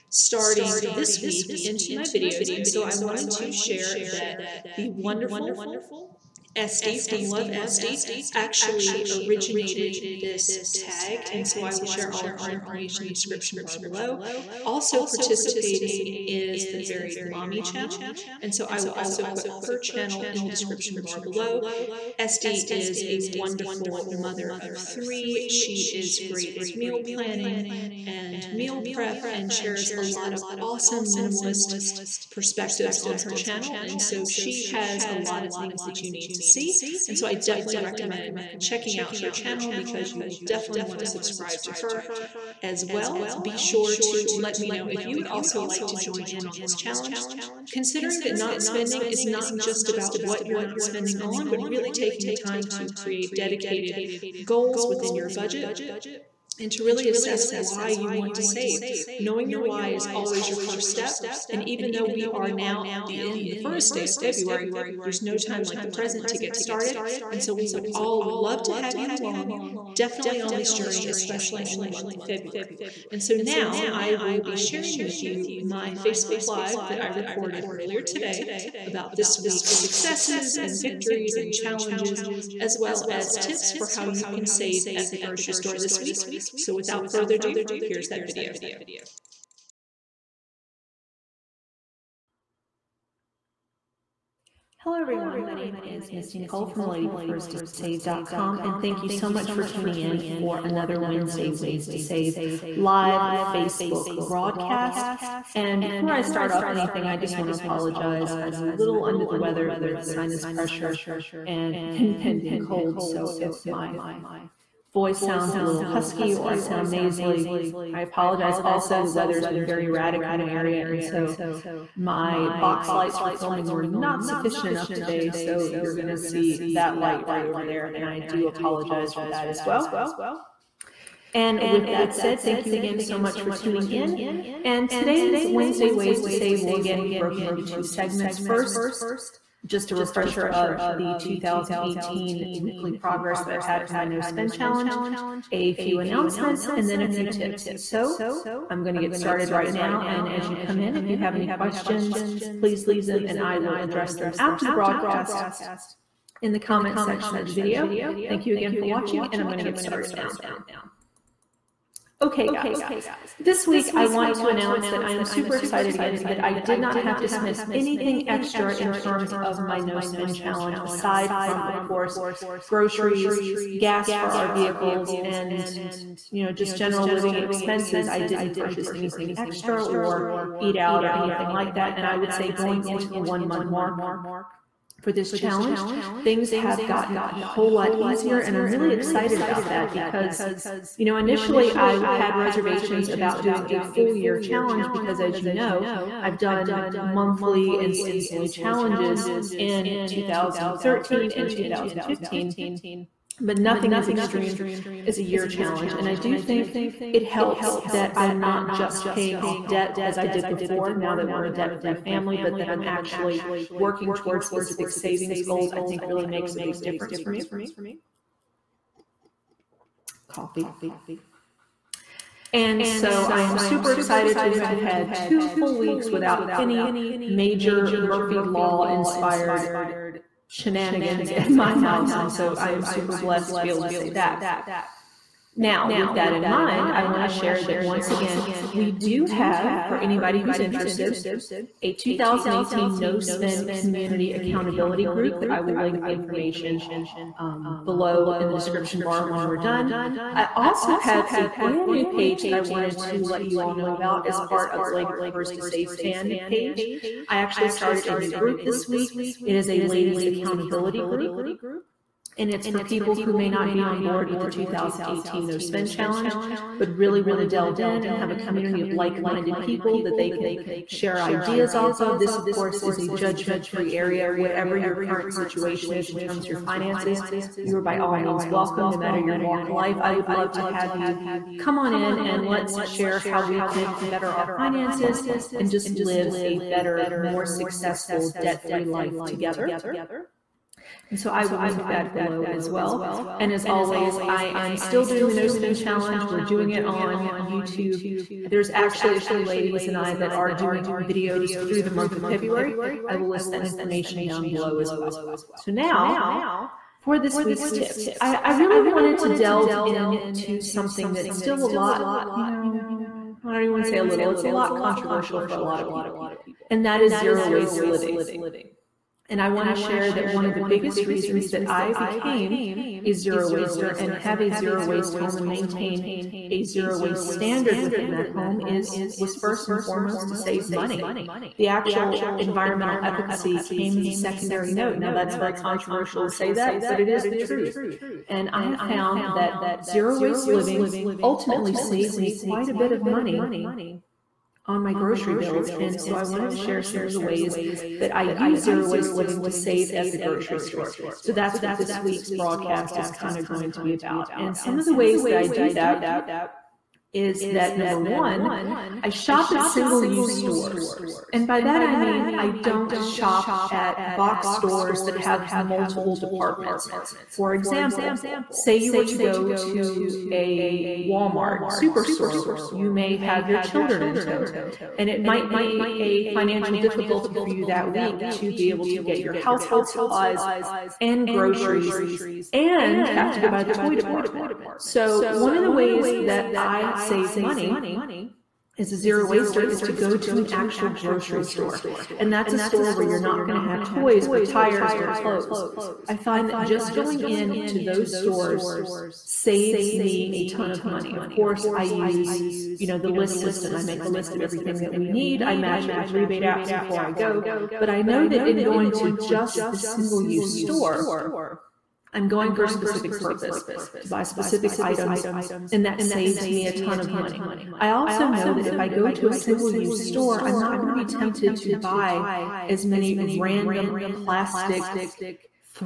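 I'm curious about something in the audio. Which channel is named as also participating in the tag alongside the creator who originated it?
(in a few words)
Varied Mommy.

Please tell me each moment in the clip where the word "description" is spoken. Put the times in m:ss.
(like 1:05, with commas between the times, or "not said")
0:13, 0:20, 4:08.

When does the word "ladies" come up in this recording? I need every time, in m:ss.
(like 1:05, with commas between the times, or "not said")
4:19, 4:59.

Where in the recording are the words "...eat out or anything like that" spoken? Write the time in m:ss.
3:00.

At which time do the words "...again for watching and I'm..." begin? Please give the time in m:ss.
2:38.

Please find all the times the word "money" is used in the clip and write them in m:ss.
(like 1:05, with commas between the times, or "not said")
5:30, 5:43, 6:27, 6:40, 6:57.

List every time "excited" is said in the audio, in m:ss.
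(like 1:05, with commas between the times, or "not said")
2:45, 3:08, 3:43.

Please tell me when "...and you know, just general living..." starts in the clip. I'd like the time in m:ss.
2:55.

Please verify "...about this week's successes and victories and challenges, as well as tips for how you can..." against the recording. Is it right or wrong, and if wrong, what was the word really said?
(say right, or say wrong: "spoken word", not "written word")
right.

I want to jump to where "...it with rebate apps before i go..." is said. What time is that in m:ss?
6:45.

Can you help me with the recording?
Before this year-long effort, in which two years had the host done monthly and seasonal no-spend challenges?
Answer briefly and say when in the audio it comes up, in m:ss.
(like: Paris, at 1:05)
2013 and 2015, at 3:20.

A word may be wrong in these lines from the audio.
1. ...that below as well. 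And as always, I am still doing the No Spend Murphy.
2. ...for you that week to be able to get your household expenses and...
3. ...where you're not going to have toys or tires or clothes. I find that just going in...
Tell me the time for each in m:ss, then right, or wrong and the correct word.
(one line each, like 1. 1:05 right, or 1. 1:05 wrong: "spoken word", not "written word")
1. 4:51 wrong: "Challenge", not "Murphy"
2. 6:17 wrong: "supplies", not "expenses"
3. 6:32 right.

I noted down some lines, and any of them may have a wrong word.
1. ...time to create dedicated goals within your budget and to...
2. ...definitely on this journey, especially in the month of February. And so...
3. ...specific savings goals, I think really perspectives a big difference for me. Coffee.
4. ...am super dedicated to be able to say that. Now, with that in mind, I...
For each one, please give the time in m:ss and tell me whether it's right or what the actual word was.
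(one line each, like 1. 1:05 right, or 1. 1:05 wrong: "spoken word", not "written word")
1. 0:52 right
2. 1:09 right
3. 3:34 wrong: "makes", not "perspectives"
4. 3:52 wrong: "blessed", not "dedicated".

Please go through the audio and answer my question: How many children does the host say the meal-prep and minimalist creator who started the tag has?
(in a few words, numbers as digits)
3.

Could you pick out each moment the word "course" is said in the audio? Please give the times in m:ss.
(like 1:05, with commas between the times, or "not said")
2:51, 4:32, 6:41.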